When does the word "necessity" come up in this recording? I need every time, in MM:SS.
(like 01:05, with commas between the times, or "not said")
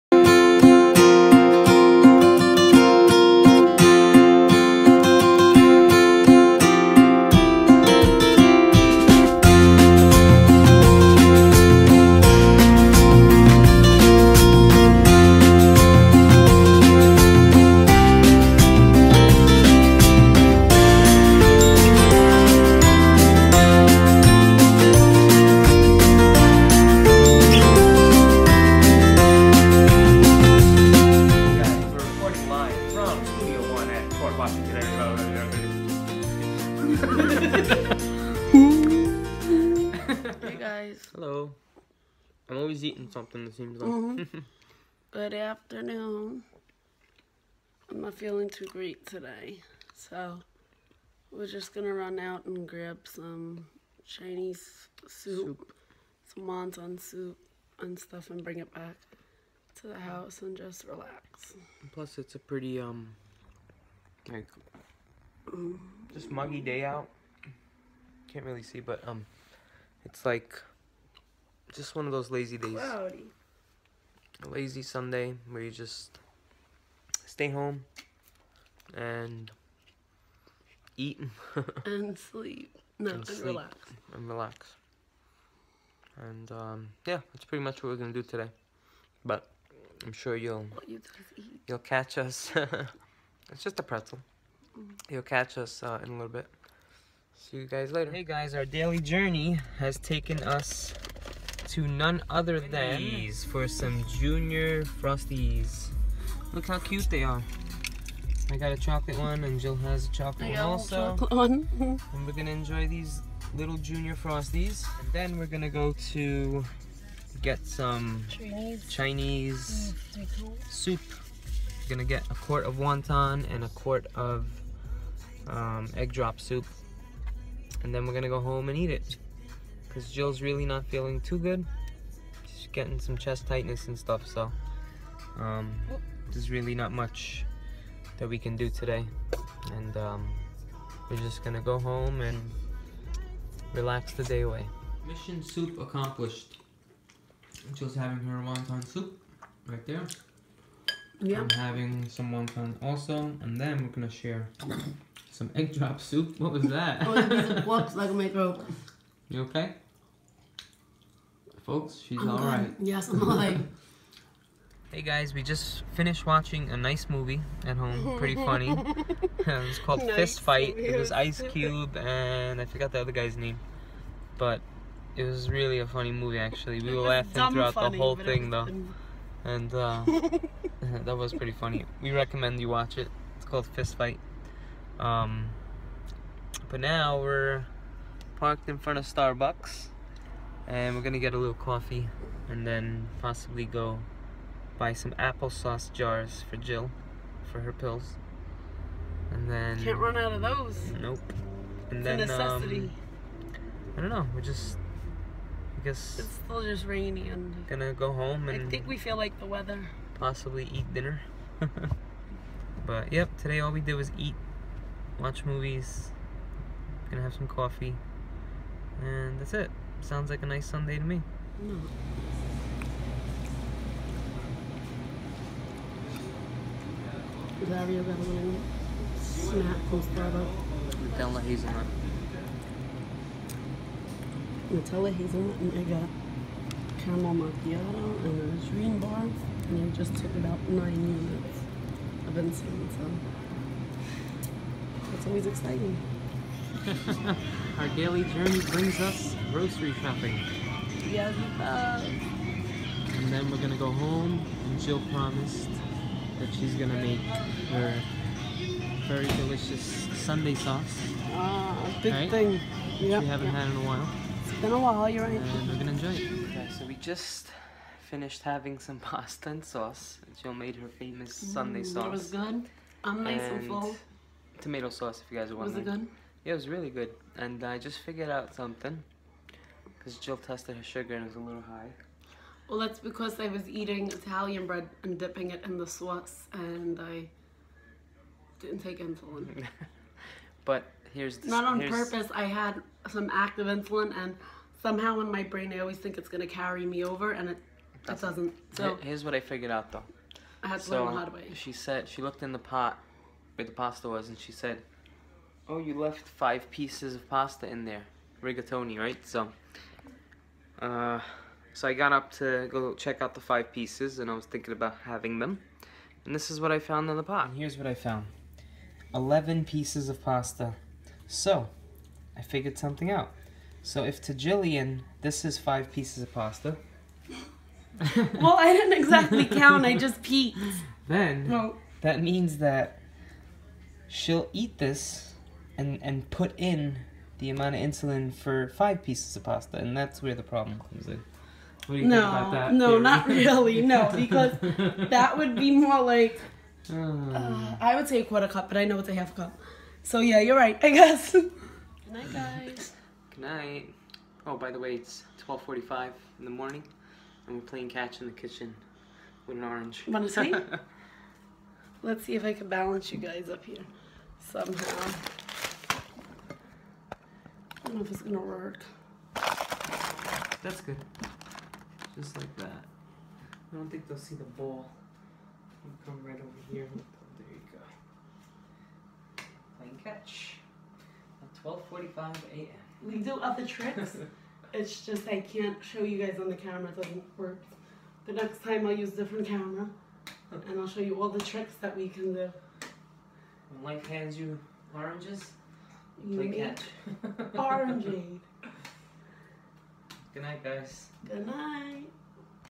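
03:22.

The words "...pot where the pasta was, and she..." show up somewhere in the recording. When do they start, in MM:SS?
05:02.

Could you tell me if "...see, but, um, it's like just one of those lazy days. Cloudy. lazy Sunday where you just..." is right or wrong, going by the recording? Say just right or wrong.
right.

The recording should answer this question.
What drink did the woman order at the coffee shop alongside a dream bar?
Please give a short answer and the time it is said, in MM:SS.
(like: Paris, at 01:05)
Caramel macchiato, at 03:57.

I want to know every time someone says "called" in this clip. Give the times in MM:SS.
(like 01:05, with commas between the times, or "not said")
02:49, 03:03.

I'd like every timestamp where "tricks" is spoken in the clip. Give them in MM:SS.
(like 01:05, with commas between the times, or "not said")
06:23, 06:31.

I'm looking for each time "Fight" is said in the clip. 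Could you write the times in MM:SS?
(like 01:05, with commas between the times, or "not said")
02:50, 03:03.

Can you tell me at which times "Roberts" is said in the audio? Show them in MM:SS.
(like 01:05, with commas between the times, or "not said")
not said.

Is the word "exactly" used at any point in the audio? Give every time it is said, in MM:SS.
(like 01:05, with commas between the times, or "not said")
05:28.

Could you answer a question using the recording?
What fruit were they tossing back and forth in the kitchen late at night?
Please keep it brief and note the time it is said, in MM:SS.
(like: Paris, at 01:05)
An orange, at 05:59.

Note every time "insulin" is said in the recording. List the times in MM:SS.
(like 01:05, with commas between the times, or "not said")
04:48, 04:53, 05:37.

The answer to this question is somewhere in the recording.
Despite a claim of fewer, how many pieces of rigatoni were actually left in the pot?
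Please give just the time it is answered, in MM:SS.
05:19.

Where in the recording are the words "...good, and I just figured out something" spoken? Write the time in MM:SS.
04:36.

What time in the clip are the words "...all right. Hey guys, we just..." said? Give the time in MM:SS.
02:43.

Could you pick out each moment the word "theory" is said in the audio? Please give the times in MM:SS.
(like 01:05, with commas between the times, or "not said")
05:42.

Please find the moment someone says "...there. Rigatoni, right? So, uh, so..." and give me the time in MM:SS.
05:07.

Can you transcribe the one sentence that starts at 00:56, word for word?
some wonton soup and stuff and bring it back to the house and just relax.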